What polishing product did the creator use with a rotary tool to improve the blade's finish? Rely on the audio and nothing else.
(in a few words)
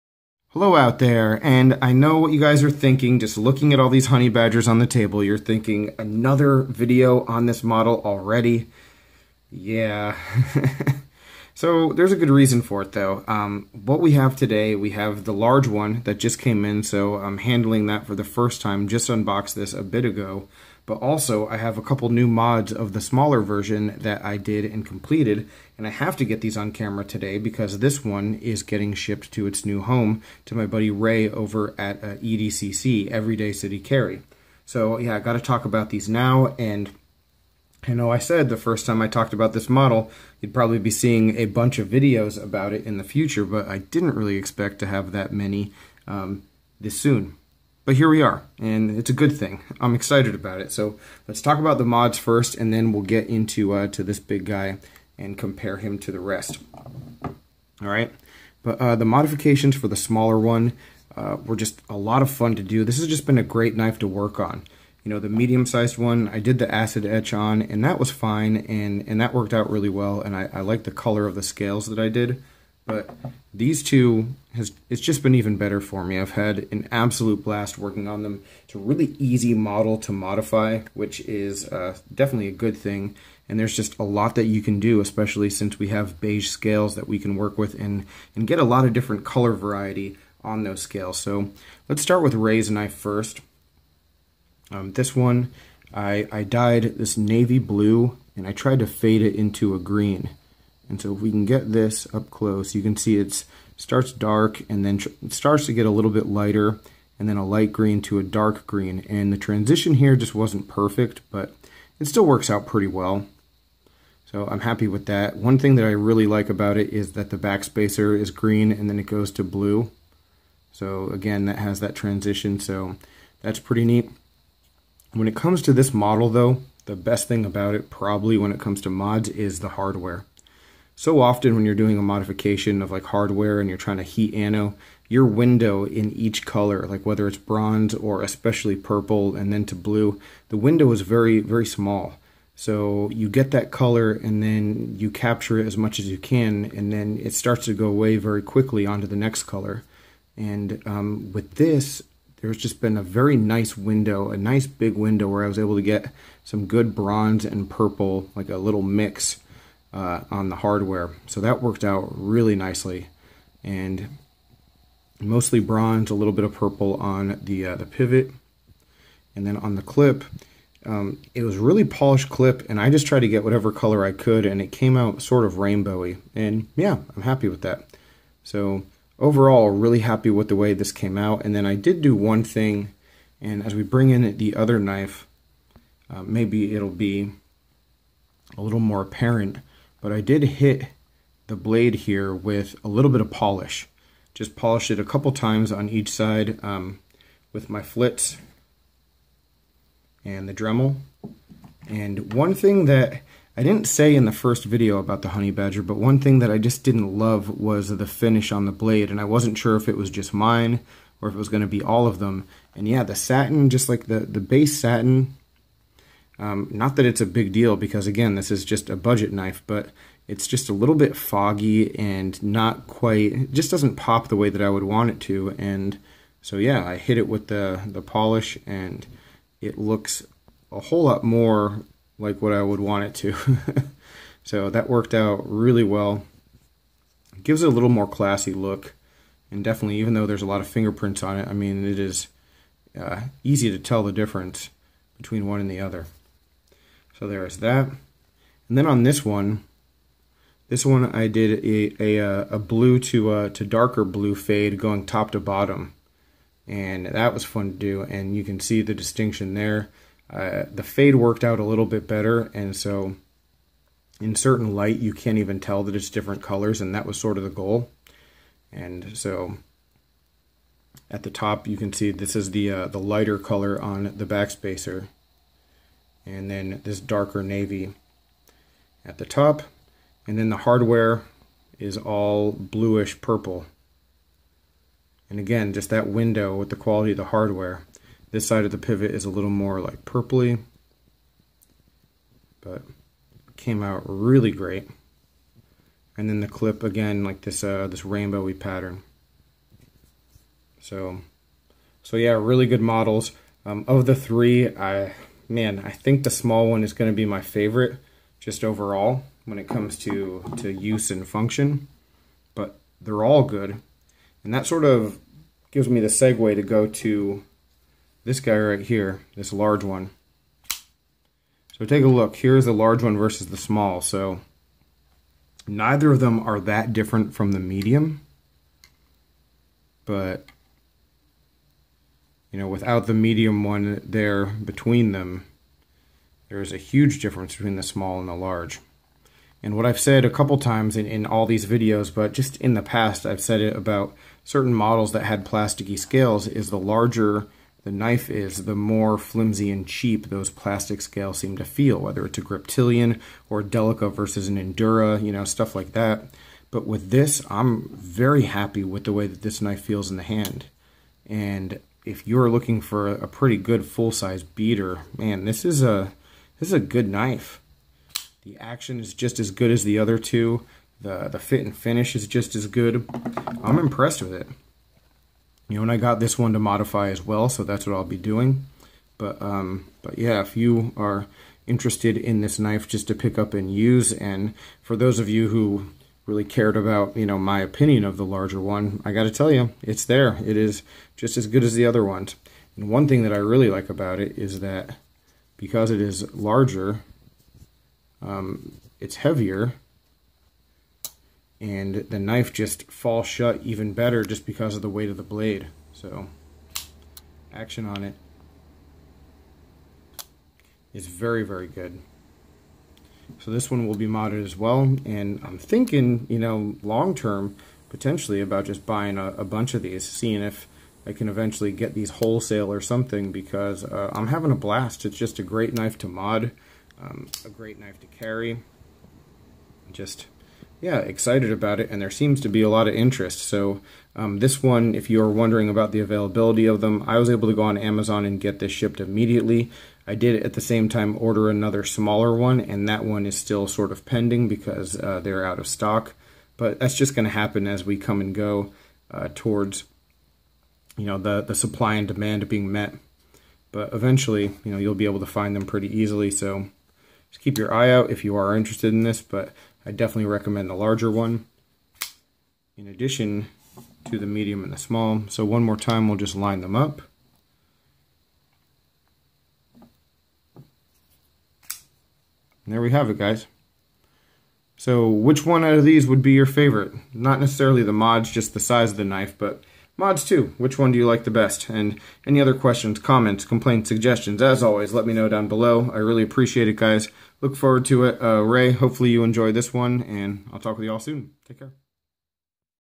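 Flitz.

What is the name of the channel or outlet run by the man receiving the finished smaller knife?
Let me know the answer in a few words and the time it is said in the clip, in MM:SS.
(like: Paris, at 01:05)
Everyday City Carry, at 00:33.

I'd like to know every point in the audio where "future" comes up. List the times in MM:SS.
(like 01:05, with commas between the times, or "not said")
00:43.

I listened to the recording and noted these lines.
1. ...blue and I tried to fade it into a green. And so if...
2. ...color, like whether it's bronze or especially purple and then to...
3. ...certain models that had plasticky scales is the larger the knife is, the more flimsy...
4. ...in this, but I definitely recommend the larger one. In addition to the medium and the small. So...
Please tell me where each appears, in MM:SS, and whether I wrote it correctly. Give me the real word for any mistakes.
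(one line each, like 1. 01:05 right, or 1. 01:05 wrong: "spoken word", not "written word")
1. 01:37 right
2. 02:16 right
3. 05:44 right
4. 07:38 right.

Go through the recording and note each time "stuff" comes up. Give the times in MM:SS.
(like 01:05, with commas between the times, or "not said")
05:55.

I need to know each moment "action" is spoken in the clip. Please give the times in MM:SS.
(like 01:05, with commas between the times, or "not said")
06:08, 06:47.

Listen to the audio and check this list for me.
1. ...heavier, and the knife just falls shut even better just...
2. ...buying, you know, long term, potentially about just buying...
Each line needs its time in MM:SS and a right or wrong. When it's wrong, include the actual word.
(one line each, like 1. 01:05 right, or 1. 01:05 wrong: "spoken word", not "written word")
1. 06:39 right
2. 06:55 wrong: "thinking", not "buying".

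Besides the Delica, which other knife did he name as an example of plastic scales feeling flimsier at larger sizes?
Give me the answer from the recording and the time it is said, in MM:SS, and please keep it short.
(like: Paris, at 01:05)
Griptilian, at 05:52.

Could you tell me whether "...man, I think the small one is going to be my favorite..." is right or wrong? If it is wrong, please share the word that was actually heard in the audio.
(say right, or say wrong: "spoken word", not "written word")
right.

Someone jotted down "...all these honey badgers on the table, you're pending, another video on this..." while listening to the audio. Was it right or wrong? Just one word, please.
wrong.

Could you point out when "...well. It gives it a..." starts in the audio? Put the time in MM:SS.
03:55.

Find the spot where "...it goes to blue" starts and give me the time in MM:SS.
01:58.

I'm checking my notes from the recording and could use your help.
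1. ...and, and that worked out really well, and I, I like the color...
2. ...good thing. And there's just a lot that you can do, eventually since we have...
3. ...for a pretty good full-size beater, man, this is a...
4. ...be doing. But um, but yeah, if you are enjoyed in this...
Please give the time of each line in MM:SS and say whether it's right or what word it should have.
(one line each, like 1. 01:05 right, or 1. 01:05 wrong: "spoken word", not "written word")
1. 01:08 right
2. 01:22 wrong: "especially", not "eventually"
3. 06:02 right
4. 06:18 wrong: "interested", not "enjoyed".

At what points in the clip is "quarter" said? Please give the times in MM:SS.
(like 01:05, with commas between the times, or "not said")
not said.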